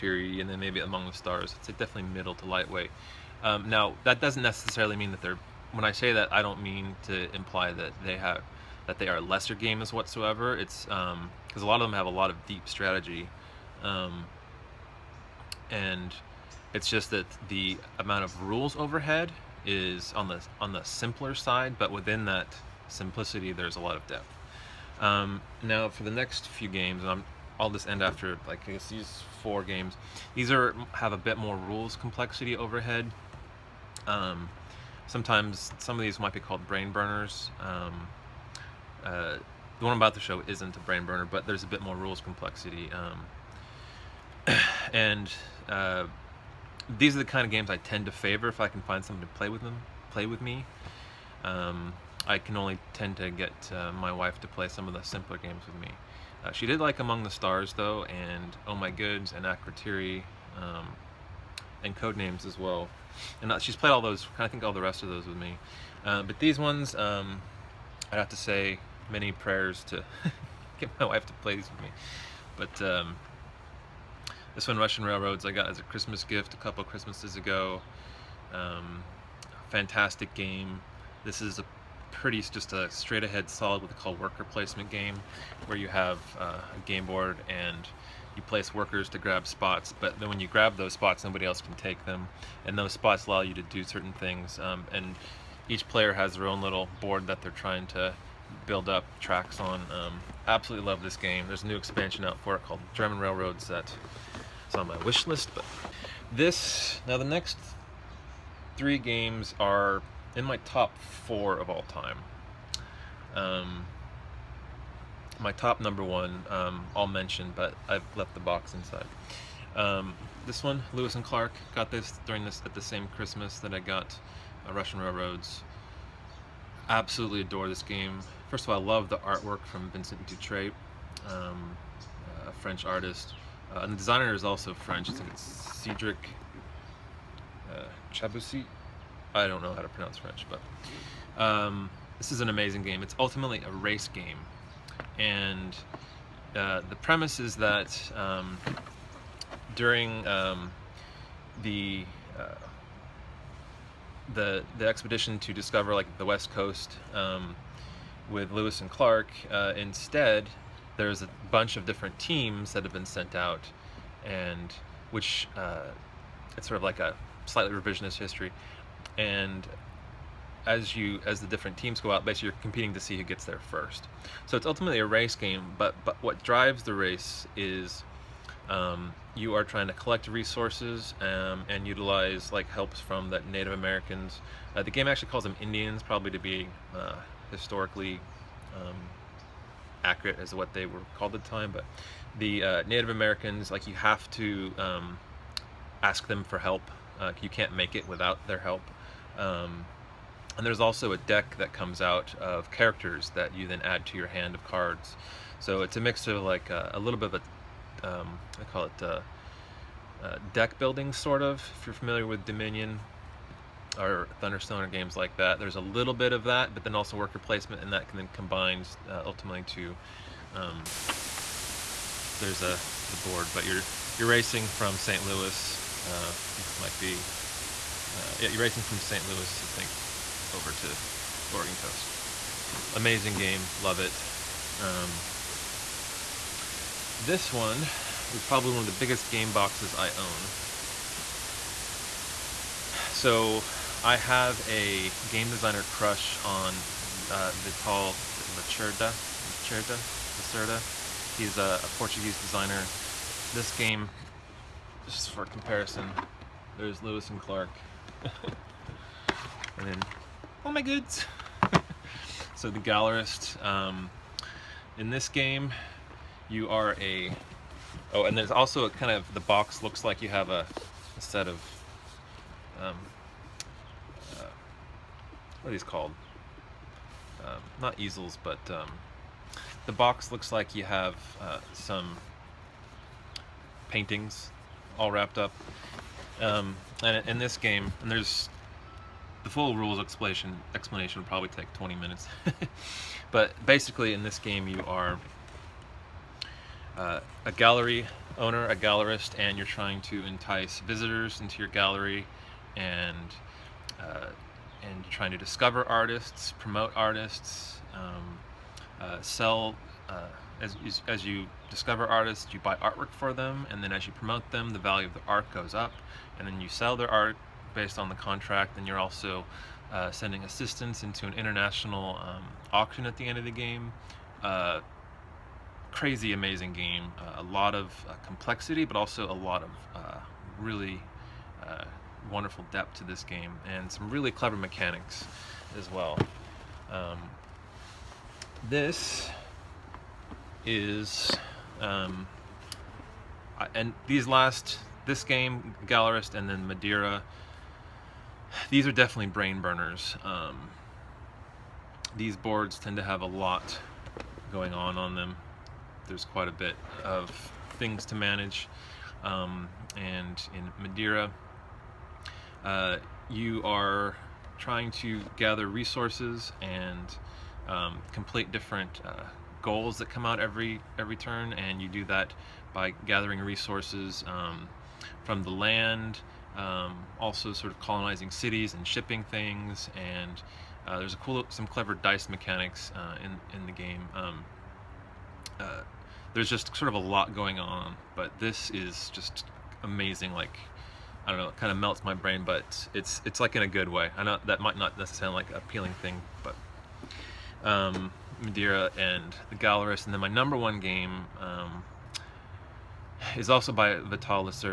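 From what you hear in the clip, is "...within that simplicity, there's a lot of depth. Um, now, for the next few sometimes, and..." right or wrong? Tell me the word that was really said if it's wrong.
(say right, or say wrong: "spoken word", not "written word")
wrong: "games", not "sometimes".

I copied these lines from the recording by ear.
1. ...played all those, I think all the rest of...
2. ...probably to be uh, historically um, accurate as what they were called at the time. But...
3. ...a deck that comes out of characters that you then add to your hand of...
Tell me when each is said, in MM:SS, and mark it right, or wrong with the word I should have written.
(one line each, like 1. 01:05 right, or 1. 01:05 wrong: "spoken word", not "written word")
1. 01:03 right
2. 03:06 right
3. 03:21 right.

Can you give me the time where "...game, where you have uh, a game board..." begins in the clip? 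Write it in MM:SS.
01:24.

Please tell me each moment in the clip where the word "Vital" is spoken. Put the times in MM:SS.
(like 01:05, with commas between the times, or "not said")
04:07, 06:43.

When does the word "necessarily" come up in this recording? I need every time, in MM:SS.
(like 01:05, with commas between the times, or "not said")
00:04, 06:34.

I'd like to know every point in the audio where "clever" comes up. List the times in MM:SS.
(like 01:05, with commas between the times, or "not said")
05:34, 06:21.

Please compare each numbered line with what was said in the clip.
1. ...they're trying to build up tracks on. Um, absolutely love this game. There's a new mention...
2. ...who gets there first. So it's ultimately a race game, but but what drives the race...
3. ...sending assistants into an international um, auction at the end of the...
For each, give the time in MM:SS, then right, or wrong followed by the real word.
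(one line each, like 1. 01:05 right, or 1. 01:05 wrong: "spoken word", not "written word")
1. 01:37 wrong: "expansion", not "mention"
2. 02:53 right
3. 05:20 right.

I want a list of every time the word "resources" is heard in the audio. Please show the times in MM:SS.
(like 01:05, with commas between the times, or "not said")
03:00, 06:05, 06:13.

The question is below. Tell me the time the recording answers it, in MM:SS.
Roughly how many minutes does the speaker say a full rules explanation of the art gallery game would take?
04:51.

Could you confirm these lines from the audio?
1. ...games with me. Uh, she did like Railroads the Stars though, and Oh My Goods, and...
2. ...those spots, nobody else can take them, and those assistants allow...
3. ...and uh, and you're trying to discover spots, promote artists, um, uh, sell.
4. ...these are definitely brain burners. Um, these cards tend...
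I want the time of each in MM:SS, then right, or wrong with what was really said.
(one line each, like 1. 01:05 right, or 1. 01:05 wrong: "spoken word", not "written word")
1. 00:55 wrong: "Among", not "Railroads"
2. 01:30 wrong: "spots", not "assistants"
3. 05:02 wrong: "artists", not "spots"
4. 05:48 wrong: "boards", not "cards".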